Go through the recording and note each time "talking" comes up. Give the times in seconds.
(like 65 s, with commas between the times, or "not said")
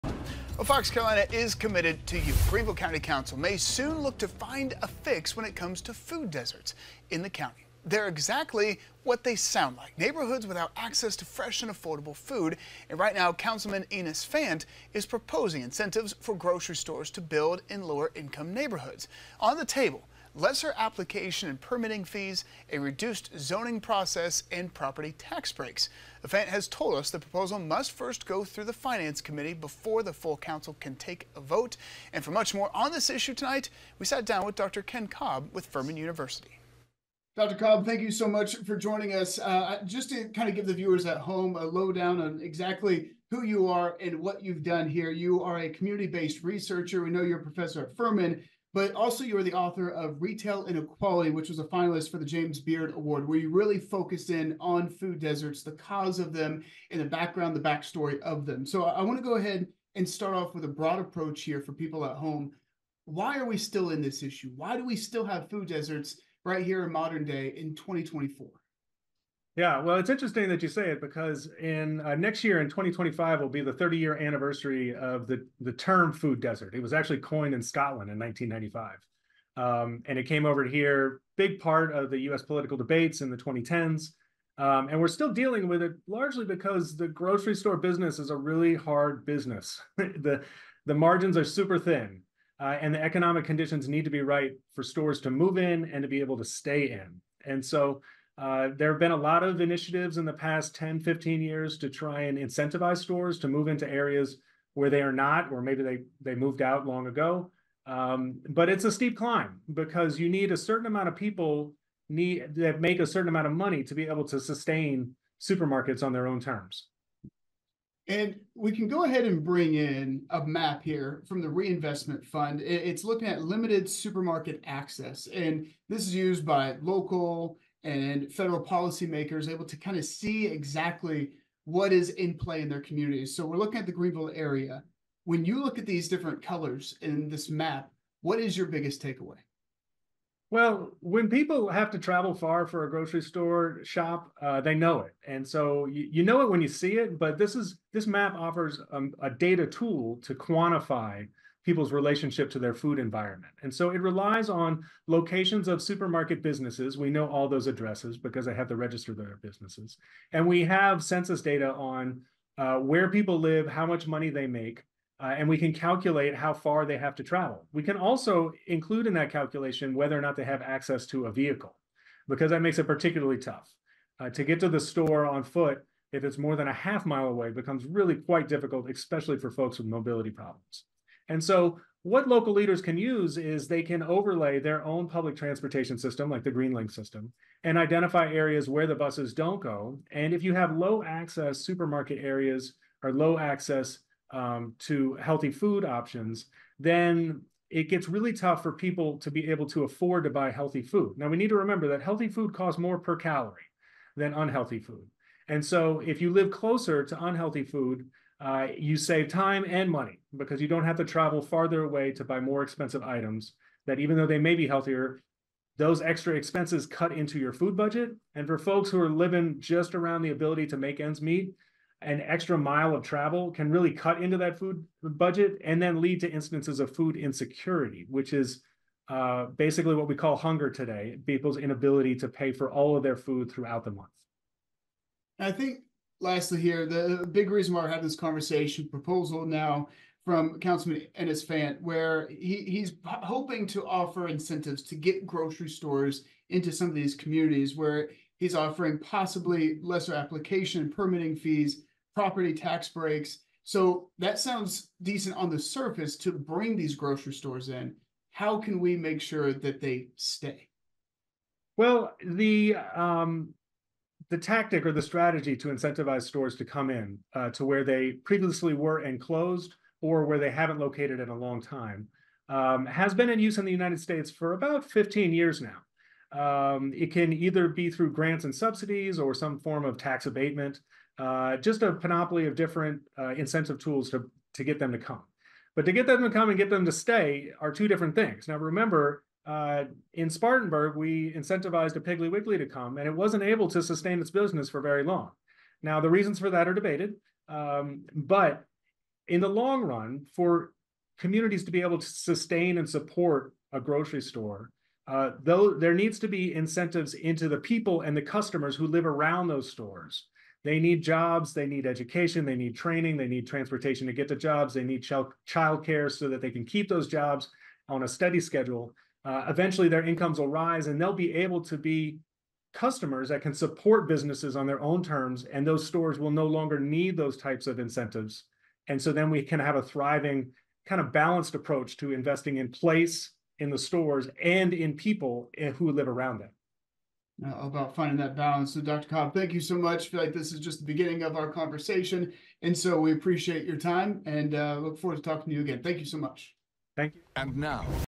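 345 s.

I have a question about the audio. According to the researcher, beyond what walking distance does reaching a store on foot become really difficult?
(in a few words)
half mile.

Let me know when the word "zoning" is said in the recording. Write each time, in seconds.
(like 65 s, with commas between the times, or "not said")
23 s.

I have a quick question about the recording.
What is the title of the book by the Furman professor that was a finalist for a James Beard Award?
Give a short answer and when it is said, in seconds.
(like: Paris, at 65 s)
Retail Inequality, at 50 s.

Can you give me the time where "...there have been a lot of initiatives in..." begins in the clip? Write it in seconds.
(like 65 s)
98 s.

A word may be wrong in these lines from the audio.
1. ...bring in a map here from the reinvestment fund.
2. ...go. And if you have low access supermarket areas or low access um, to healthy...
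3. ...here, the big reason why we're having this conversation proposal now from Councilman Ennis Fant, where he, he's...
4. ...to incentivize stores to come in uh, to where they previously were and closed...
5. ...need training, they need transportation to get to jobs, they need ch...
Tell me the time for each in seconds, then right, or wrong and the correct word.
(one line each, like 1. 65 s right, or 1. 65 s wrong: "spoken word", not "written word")
1. 119 s right
2. 189 s right
3. 236 s right
4. 265 s right
5. 312 s right.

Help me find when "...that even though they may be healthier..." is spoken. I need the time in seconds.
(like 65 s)
213 s.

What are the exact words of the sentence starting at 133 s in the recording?
So we're looking at the Greenville area.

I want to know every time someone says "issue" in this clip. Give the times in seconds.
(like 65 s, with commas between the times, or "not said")
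33 s, 64 s.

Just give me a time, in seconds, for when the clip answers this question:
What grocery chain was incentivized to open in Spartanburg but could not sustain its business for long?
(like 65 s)
291 s.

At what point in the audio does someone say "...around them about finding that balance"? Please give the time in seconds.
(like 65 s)
336 s.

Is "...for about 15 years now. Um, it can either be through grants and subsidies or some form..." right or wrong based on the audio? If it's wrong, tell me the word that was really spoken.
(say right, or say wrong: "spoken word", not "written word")
right.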